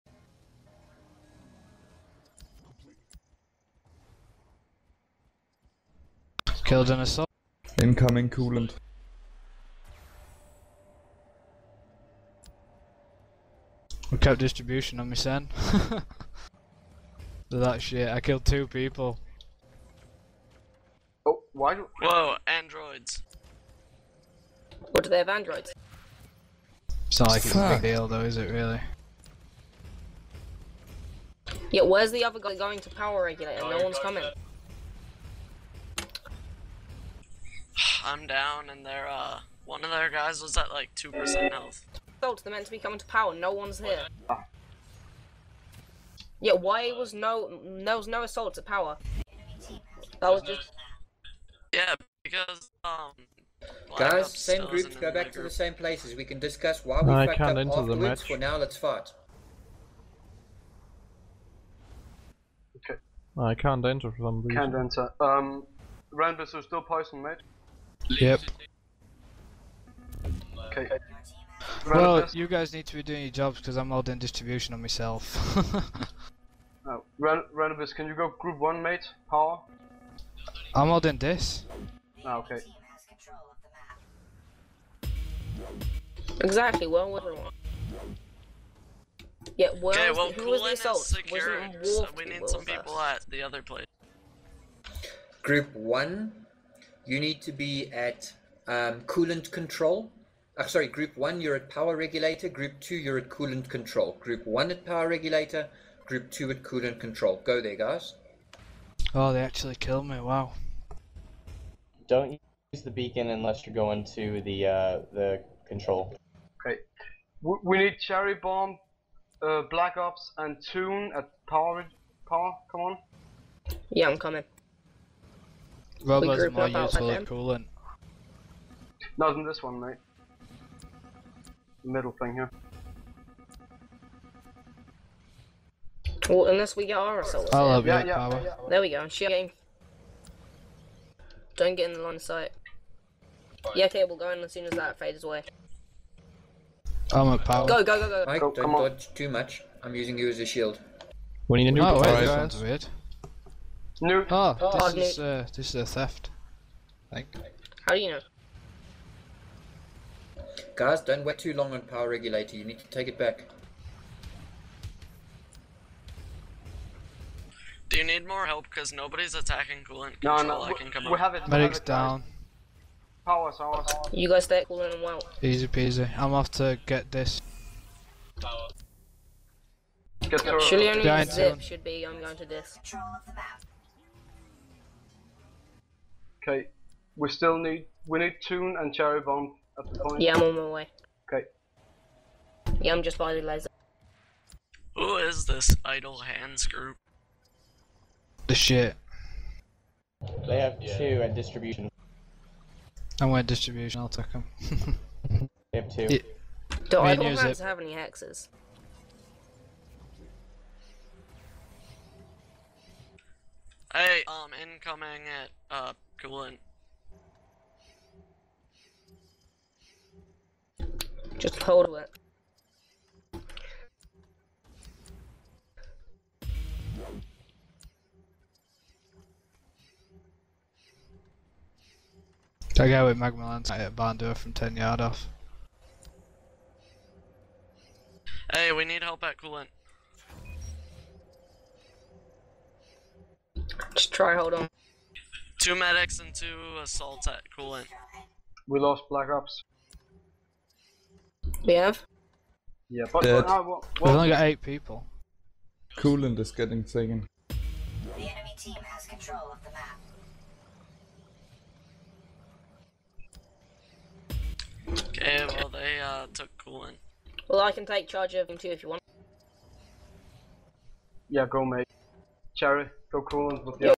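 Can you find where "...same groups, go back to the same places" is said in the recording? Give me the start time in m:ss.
0:54.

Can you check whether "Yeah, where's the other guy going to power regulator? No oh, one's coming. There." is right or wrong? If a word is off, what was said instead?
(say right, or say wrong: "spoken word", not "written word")
right.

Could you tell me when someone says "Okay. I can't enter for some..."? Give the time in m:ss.
1:02.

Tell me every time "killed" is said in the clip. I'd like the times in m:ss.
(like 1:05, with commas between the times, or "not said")
0:06, 0:18, 1:49.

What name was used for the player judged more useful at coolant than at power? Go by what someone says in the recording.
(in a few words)
Robo.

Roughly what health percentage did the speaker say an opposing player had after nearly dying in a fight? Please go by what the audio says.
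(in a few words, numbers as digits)
2%.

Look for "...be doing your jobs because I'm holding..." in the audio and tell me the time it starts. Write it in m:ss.
1:12.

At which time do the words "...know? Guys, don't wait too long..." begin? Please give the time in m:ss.
2:38.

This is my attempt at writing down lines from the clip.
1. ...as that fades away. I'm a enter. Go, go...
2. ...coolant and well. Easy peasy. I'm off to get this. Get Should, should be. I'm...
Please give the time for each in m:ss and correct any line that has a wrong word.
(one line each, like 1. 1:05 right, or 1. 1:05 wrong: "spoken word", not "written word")
1. 2:24 wrong: "power", not "enter"
2. 2:54 right.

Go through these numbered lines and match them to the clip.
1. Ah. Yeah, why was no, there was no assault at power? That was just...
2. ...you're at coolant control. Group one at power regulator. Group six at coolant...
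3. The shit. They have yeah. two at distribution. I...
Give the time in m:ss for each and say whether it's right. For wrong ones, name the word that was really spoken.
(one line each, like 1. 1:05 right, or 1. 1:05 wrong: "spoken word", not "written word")
1. 0:44 right
2. 1:42 wrong: "two", not "six"
3. 3:18 right.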